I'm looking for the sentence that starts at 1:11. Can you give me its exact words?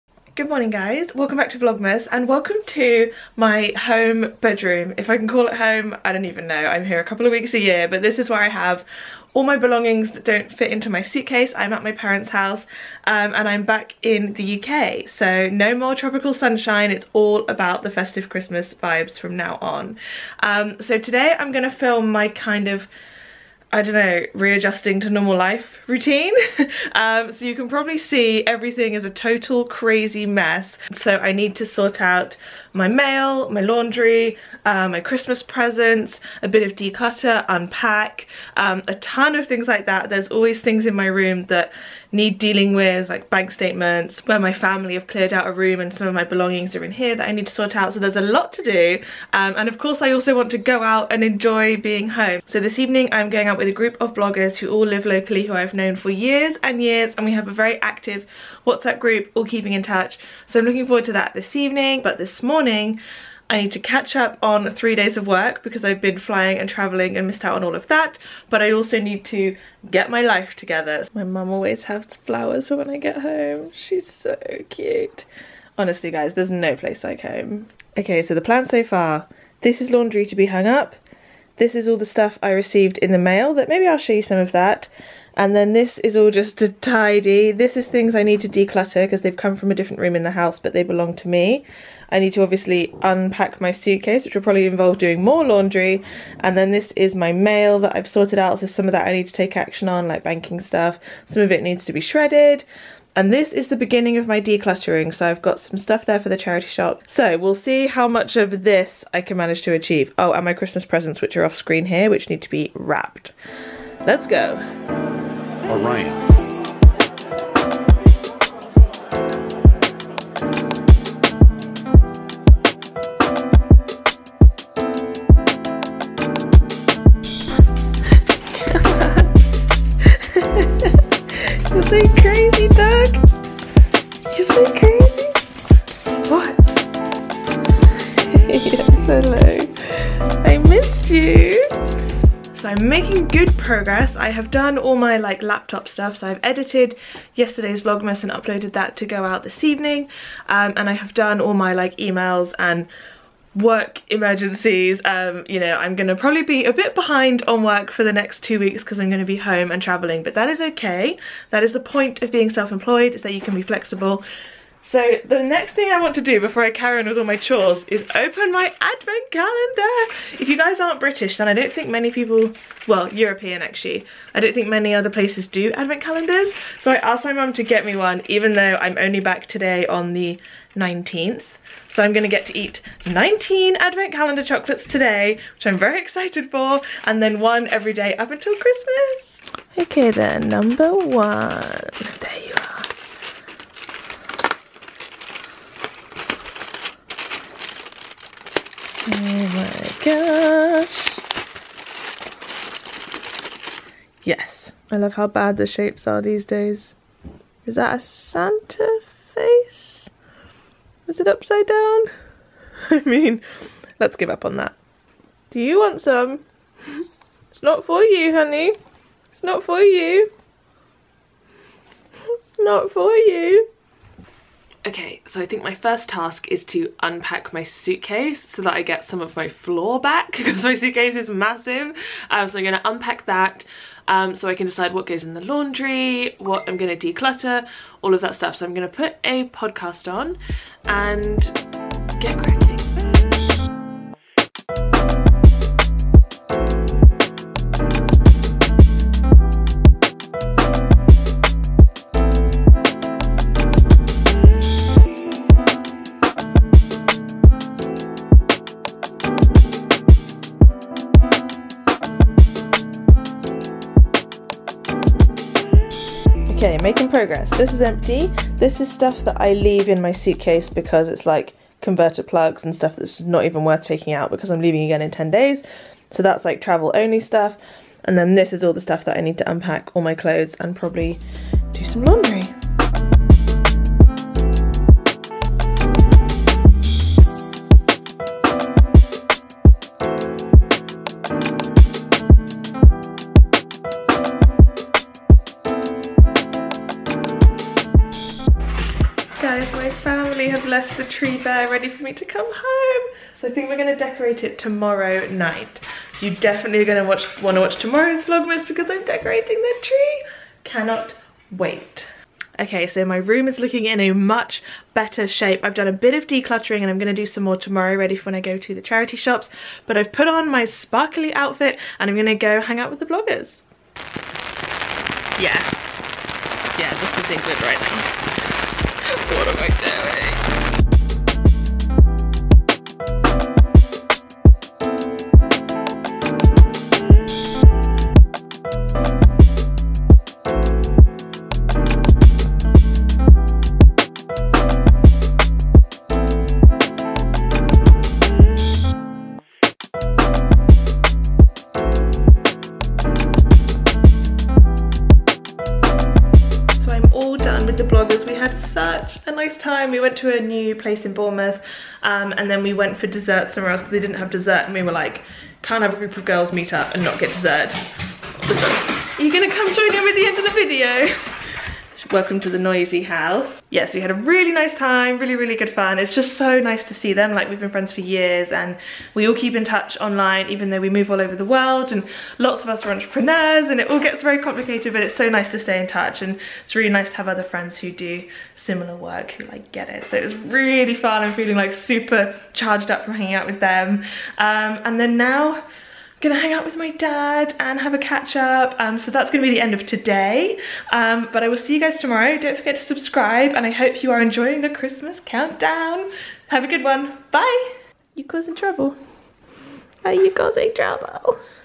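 My mum always has flowers for when I get home.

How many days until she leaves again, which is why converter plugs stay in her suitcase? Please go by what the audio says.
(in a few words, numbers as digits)
10.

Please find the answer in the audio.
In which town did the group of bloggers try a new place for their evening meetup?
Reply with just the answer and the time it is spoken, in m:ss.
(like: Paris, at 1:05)
Bournemouth, at 6:01.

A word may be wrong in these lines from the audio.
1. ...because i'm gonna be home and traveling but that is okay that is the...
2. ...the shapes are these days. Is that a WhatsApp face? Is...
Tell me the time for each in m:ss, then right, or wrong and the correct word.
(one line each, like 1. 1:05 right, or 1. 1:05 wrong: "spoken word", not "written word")
1. 2:38 right
2. 3:25 wrong: "Santa", not "WhatsApp".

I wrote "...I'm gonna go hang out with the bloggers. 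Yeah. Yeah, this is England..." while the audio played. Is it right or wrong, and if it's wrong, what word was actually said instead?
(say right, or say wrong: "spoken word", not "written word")
right.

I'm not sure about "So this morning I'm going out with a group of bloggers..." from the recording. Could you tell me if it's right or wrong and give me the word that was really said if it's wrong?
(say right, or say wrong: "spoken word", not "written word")
wrong: "evening", not "morning".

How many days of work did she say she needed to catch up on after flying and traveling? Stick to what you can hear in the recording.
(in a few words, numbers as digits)
3.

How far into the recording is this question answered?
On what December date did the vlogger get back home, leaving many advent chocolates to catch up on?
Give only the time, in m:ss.
3:00.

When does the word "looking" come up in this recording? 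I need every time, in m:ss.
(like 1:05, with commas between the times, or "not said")
1:00, 5:13.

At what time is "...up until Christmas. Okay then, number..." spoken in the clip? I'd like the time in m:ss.
3:08.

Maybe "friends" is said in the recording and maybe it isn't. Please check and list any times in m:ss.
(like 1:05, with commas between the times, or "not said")
6:17, 6:27.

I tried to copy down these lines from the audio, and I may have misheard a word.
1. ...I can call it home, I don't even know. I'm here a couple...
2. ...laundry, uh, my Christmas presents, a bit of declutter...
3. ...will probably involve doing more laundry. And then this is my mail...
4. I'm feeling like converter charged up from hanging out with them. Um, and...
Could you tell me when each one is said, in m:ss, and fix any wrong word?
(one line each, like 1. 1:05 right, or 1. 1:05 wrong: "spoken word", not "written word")
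1. 0:05 right
2. 0:33 right
3. 1:34 right
4. 6:31 wrong: "super", not "converter".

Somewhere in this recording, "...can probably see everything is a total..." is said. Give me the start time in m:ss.
0:27.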